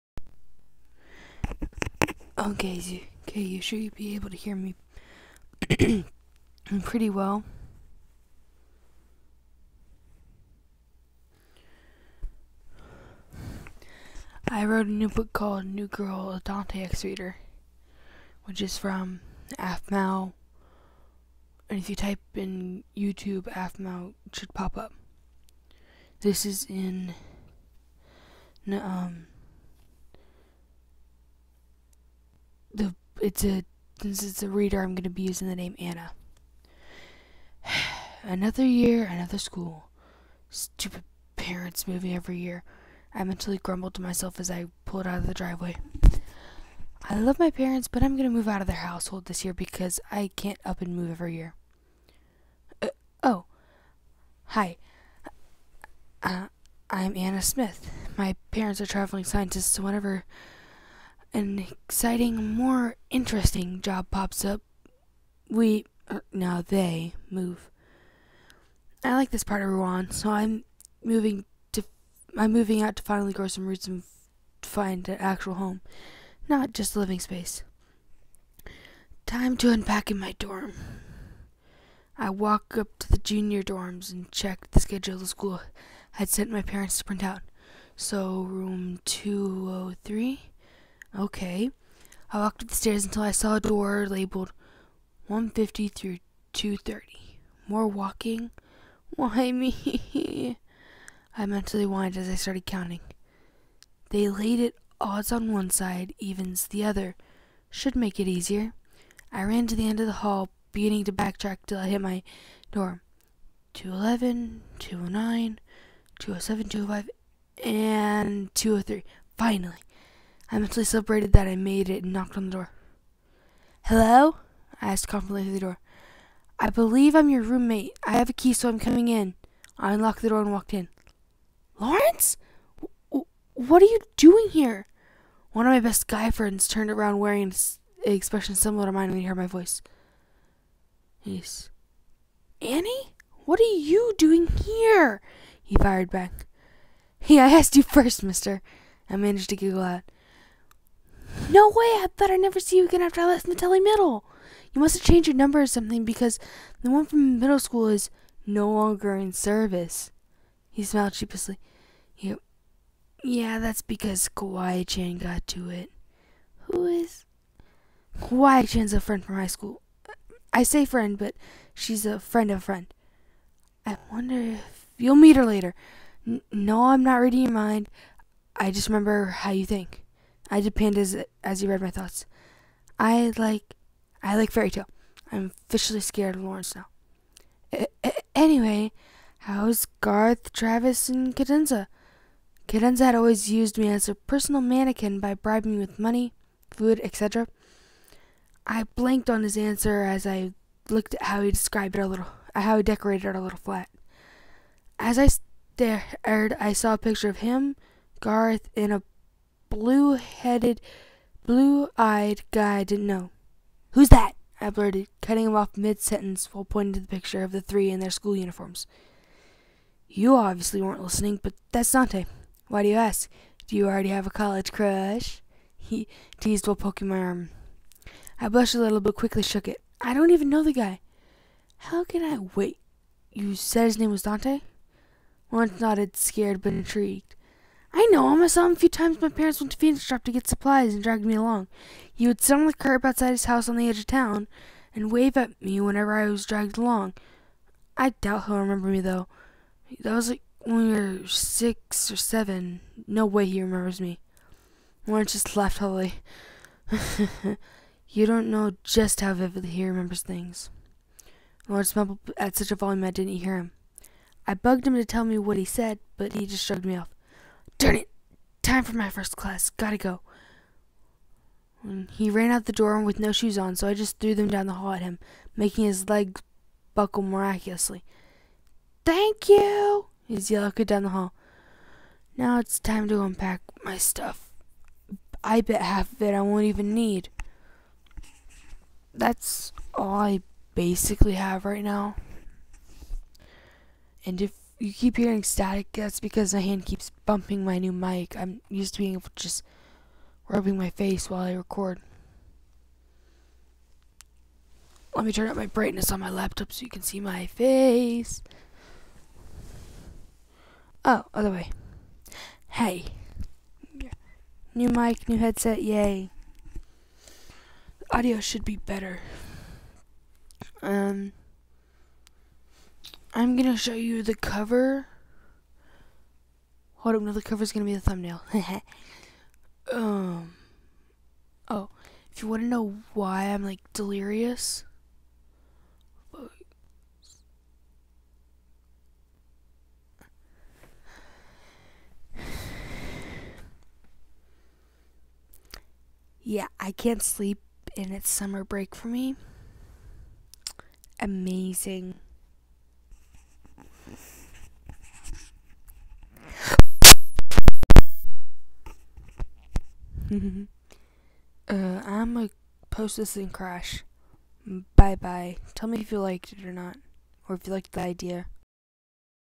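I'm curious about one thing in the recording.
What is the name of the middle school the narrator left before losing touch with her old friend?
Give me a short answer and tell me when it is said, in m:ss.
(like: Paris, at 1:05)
Metelli Middle, at 2:33.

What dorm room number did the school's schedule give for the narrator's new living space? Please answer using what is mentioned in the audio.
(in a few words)
203.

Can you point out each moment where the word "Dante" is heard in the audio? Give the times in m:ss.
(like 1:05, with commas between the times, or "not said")
0:16, 3:41, 3:54.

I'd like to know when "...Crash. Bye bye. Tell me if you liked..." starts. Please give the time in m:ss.
6:03.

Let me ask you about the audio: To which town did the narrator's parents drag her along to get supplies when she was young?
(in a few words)
Phoenix.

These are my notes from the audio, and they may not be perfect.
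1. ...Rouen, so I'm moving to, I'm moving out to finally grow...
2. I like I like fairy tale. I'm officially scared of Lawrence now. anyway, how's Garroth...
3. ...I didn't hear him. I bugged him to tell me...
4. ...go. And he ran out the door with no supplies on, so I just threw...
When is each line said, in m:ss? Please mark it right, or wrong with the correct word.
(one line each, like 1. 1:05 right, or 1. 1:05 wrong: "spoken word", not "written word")
1. 1:09 right
2. 3:02 right
3. 4:23 right
4. 4:29 wrong: "shoes", not "supplies".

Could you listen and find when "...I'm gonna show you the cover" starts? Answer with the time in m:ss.
5:23.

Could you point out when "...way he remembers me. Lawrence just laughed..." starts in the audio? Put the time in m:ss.
4:13.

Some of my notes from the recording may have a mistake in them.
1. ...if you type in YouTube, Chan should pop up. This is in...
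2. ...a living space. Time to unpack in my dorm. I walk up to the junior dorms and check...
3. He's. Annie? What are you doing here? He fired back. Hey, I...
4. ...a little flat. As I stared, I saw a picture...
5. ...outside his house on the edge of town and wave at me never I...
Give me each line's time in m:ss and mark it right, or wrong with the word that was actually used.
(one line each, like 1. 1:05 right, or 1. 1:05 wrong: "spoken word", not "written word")
1. 0:21 wrong: "AFMAL", not "Chan"
2. 1:16 right
3. 2:21 right
4. 3:23 right
5. 4:03 wrong: "whenever", not "never".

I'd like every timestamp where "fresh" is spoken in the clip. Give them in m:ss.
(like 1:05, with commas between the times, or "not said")
not said.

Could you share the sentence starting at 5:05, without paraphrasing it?
Let me turn up my brightness on my laptop so you can see my face.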